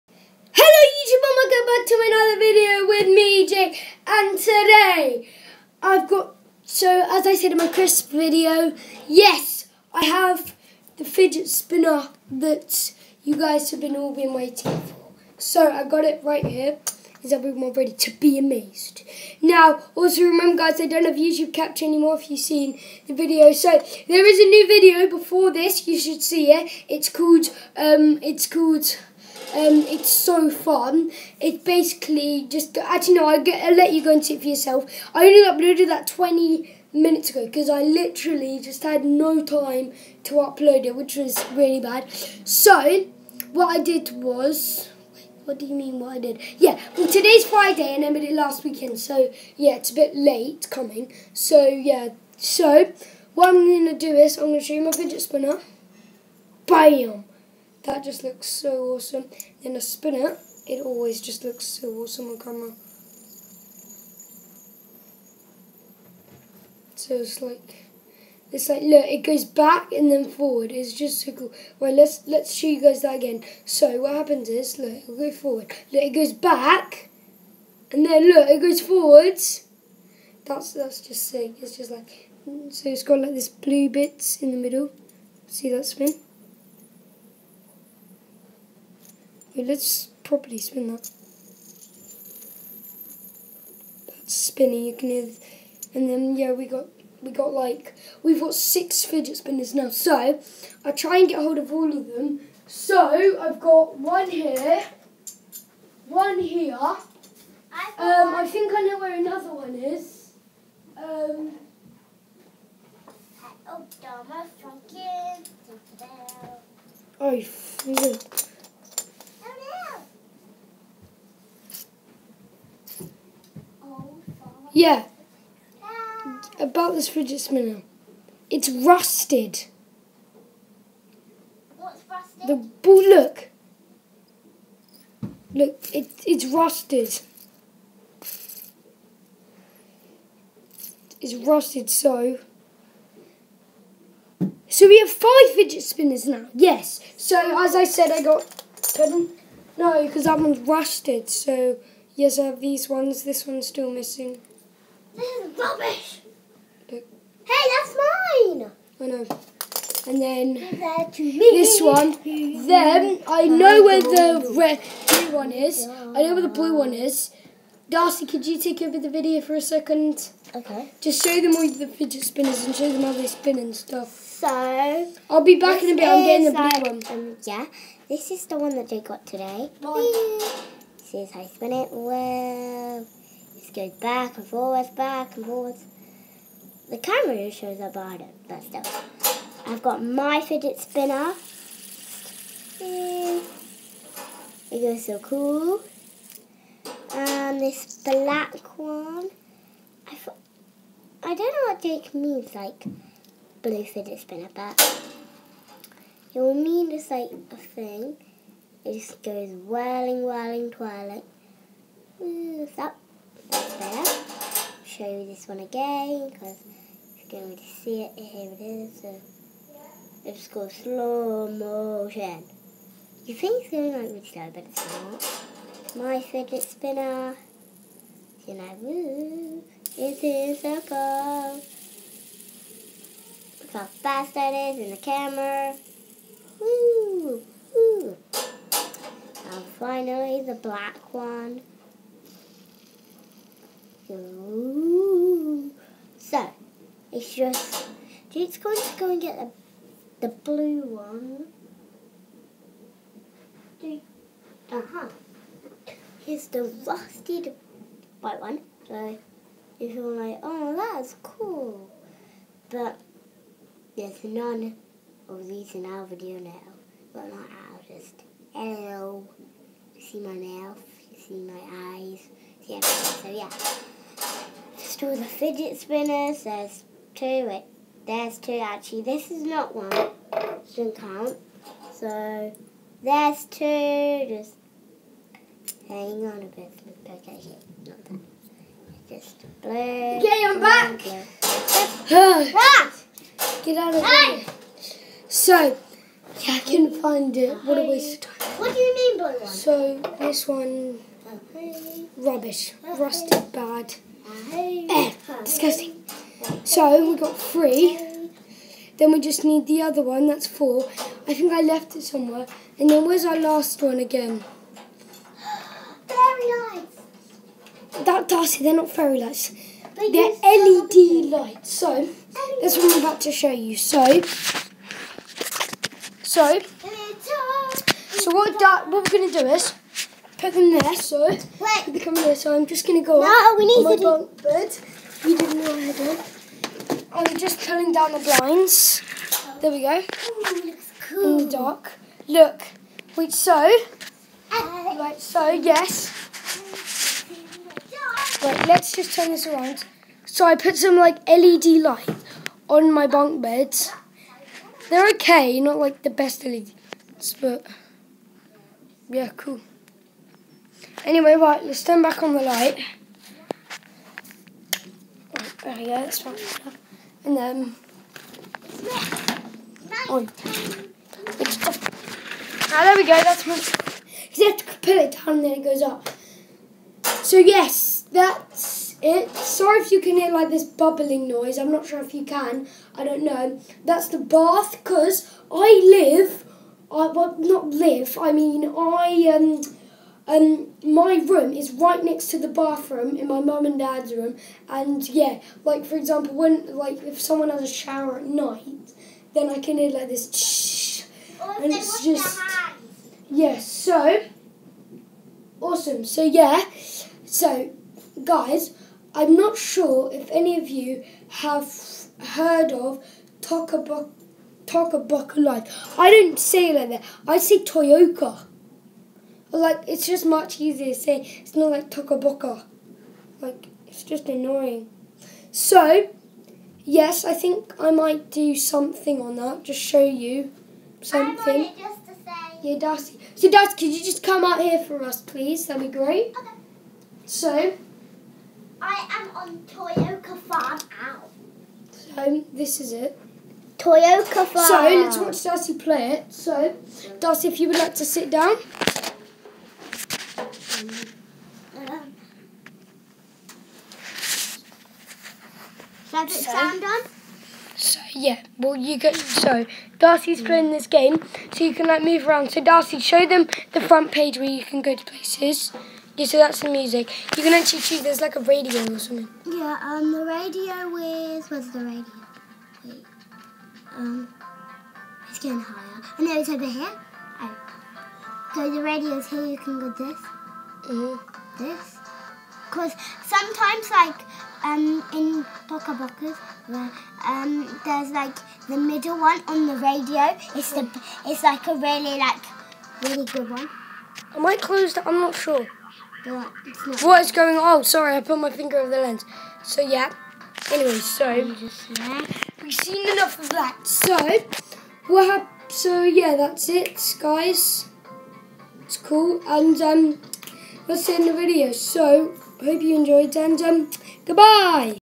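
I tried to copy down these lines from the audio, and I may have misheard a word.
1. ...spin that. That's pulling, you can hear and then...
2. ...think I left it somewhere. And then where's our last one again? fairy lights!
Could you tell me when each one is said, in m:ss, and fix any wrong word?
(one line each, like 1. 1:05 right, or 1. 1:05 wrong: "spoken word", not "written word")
1. 1:30 wrong: "spinning", not "pulling"
2. 5:11 right.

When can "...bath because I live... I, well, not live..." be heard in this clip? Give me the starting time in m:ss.
6:24.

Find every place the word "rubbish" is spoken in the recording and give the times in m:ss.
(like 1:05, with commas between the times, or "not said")
2:35, 5:02.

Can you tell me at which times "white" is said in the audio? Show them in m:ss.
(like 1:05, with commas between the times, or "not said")
4:18.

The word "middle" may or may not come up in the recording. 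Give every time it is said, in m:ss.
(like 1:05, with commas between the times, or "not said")
1:24, 8:08.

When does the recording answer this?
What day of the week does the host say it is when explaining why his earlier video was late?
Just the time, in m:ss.
0:47.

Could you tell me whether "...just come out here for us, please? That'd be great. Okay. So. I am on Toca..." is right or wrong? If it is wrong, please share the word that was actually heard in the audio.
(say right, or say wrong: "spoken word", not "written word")
wrong: "Toyoka", not "Toca".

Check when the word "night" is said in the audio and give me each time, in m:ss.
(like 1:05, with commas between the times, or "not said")
6:38.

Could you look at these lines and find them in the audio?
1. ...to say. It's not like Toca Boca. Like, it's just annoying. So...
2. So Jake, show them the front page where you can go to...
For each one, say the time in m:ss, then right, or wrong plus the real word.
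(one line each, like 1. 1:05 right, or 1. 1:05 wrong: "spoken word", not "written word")
1. 7:00 right
2. 7:42 wrong: "Darcy", not "Jake".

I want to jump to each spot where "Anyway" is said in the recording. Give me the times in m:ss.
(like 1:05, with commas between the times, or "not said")
6:01, 8:20.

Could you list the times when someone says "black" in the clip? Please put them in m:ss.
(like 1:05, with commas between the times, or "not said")
3:18, 4:00.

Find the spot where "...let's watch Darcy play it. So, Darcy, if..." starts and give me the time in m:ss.
7:24.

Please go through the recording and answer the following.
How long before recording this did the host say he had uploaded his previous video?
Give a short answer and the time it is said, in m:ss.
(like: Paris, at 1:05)
20 minutes ago, at 0:36.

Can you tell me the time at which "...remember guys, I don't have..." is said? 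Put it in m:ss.
0:20.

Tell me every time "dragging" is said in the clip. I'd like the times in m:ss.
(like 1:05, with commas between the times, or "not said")
not said.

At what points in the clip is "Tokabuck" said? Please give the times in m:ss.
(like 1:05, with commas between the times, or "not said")
6:54.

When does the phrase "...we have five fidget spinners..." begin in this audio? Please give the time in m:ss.
2:24.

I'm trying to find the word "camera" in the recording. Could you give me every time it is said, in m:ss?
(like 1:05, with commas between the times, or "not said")
1:02, 3:06, 3:54.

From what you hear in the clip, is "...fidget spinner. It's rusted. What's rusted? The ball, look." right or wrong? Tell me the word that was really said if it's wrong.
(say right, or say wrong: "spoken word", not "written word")
right.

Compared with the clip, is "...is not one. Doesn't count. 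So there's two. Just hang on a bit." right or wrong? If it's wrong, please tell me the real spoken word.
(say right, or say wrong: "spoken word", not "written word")
right.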